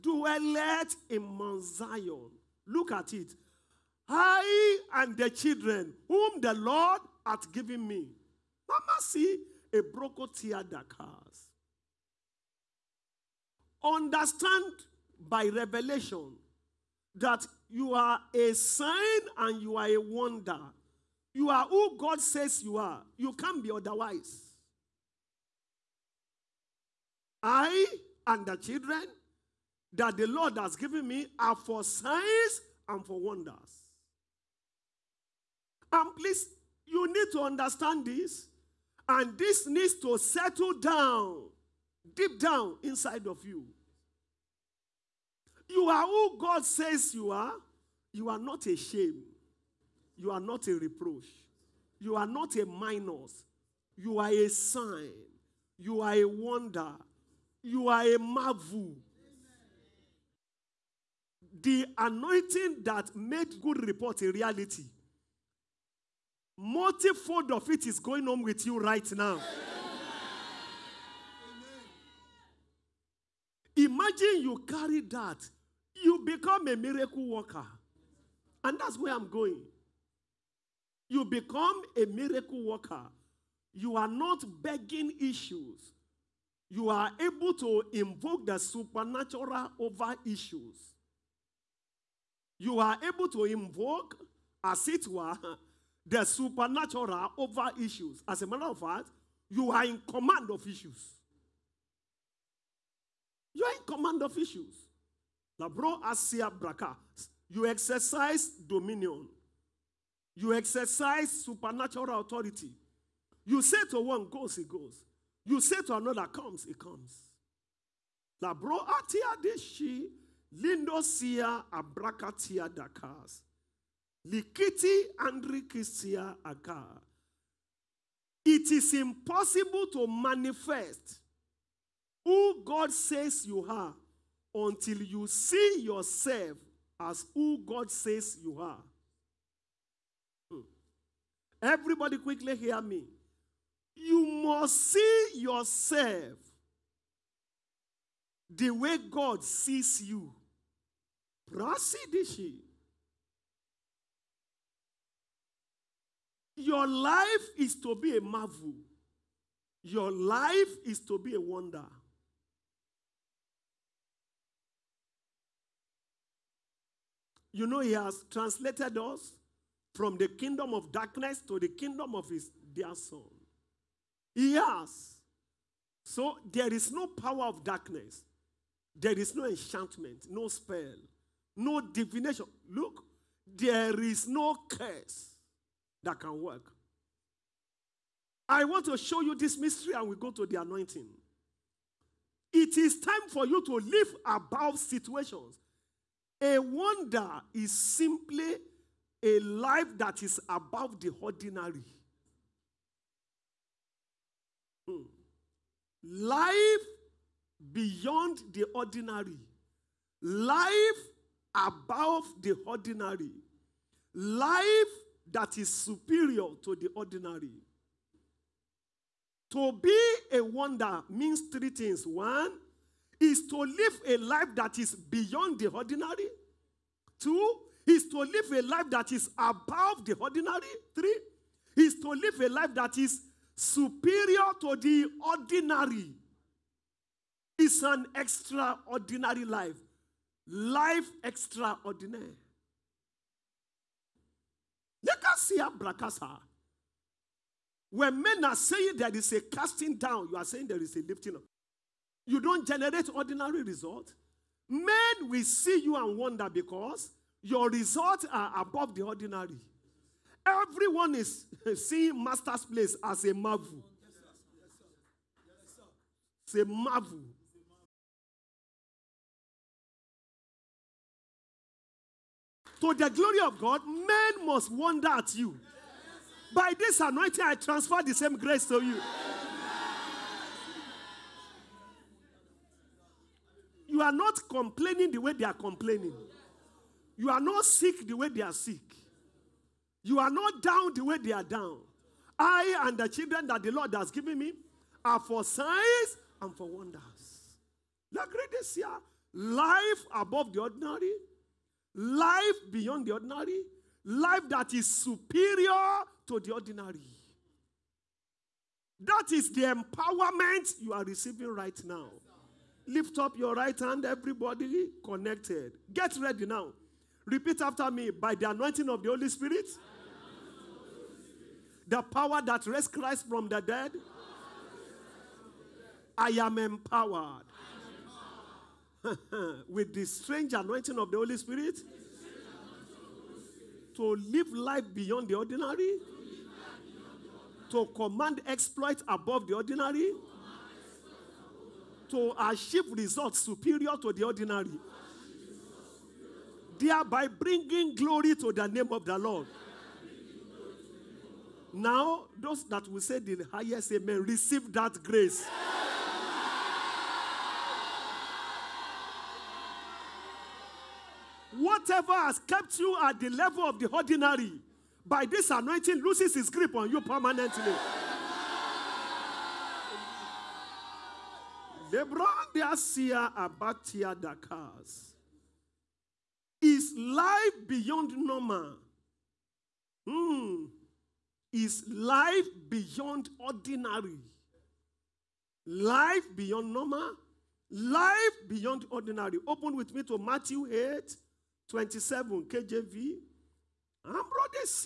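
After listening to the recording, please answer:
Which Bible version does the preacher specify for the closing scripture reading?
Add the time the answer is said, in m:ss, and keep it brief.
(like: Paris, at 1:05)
KJV, at 6:32.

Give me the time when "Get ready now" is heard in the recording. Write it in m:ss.
5:15.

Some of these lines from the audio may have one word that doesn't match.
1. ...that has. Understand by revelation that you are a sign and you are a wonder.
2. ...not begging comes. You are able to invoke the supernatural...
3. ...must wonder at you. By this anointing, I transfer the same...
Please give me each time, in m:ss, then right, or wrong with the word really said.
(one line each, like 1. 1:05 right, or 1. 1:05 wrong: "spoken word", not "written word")
1. 0:10 right
2. 1:24 wrong: "issues", not "comes"
3. 4:34 right.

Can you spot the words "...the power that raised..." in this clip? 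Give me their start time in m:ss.
5:21.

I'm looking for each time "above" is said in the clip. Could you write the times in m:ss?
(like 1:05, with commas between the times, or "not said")
3:14, 3:20, 3:31, 3:49, 4:18, 5:00, 5:39.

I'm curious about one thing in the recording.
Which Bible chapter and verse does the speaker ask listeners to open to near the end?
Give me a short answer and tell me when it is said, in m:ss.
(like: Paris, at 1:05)
Matthew 8:27, at 6:30.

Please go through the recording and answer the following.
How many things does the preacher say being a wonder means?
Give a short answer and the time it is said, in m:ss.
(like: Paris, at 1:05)
3, at 3:41.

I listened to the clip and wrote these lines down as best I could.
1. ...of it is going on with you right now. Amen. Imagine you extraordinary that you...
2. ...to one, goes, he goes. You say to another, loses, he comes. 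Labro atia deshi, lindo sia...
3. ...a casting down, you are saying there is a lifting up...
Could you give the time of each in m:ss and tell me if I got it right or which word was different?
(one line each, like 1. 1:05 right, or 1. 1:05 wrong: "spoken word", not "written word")
1. 1:07 wrong: "carry", not "extraordinary"
2. 1:53 wrong: "comes", not "loses"
3. 4:09 right.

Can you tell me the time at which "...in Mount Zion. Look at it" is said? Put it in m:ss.
0:01.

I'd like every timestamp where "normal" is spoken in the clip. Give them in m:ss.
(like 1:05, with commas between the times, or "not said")
6:18, 6:26.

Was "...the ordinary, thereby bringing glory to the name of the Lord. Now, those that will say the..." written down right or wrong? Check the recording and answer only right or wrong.
right.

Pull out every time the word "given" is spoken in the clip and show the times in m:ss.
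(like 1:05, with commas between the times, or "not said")
0:07, 0:30, 4:54.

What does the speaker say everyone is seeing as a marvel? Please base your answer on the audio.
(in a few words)
Master's Place.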